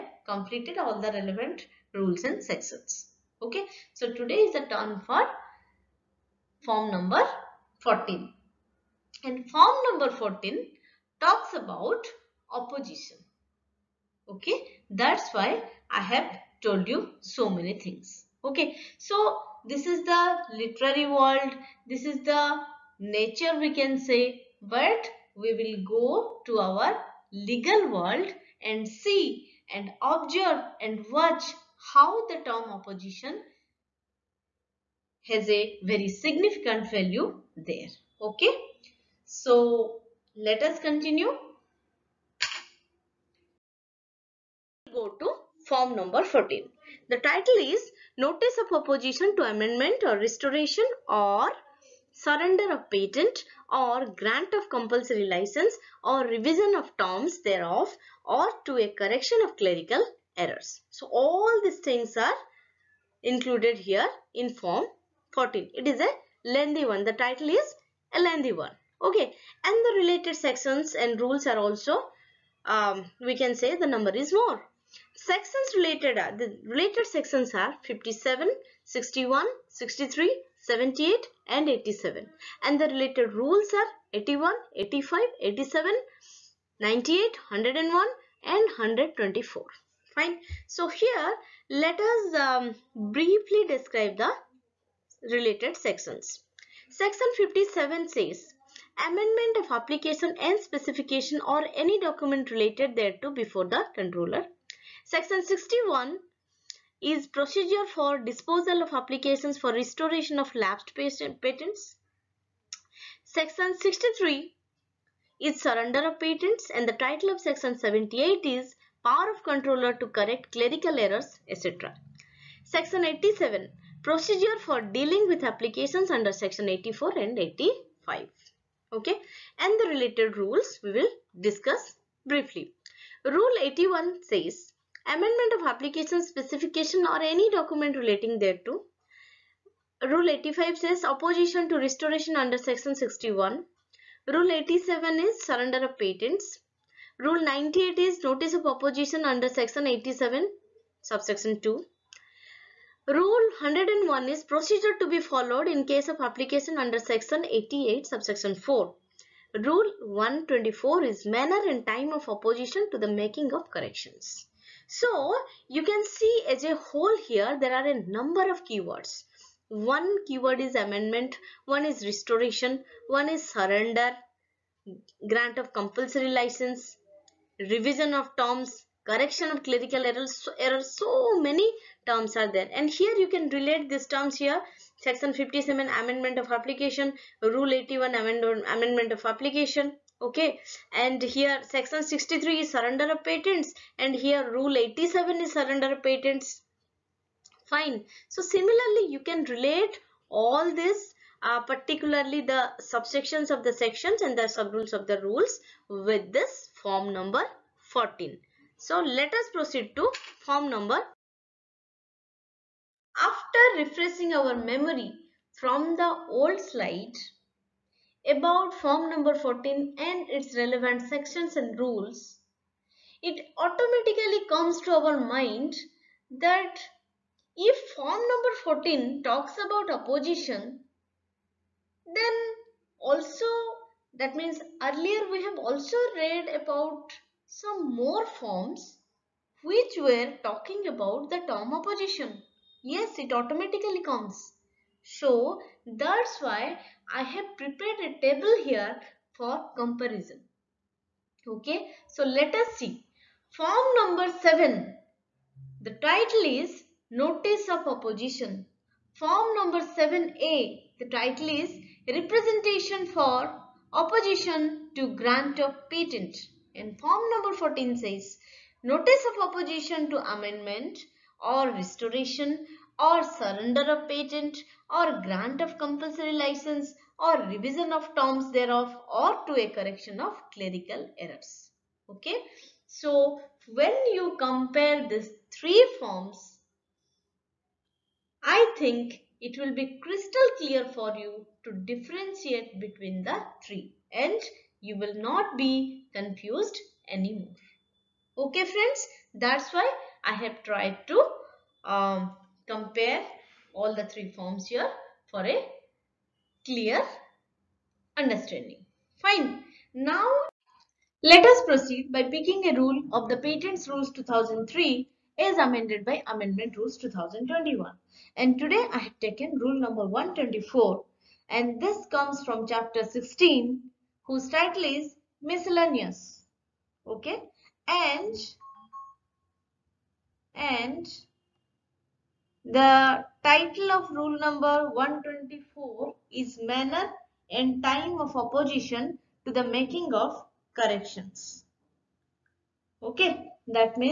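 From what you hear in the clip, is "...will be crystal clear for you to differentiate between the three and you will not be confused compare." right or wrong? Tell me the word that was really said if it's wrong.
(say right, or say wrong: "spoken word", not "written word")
wrong: "anymore", not "compare".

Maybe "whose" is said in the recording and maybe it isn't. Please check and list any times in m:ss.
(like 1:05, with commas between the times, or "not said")
5:24.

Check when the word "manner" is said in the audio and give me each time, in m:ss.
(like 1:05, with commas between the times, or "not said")
2:41, 5:36.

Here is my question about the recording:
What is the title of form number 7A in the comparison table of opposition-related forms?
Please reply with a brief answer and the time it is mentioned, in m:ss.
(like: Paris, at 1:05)
Representation for Opposition to Grant of Patent, at 4:22.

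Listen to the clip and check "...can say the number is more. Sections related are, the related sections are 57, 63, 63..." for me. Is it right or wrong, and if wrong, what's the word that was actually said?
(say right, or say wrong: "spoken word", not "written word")
wrong: "61", not "63".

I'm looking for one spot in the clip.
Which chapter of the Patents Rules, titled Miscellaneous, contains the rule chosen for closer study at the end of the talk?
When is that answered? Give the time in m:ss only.
5:22.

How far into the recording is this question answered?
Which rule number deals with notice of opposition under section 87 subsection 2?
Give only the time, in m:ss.
2:27.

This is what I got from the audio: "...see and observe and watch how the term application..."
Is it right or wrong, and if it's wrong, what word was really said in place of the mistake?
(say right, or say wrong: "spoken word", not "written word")
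wrong: "opposition", not "application".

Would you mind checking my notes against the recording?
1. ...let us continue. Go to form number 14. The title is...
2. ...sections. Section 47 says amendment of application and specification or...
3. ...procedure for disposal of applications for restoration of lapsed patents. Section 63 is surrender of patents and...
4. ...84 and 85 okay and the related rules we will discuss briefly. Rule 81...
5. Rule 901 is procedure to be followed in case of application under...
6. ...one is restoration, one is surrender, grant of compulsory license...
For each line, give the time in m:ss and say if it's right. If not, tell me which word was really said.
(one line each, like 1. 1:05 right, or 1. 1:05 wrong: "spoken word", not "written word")
1. 0:40 right
2. 1:35 wrong: "57", not "47"
3. 1:47 right
4. 2:06 right
5. 2:33 wrong: "101", not "901"
6. 2:51 right.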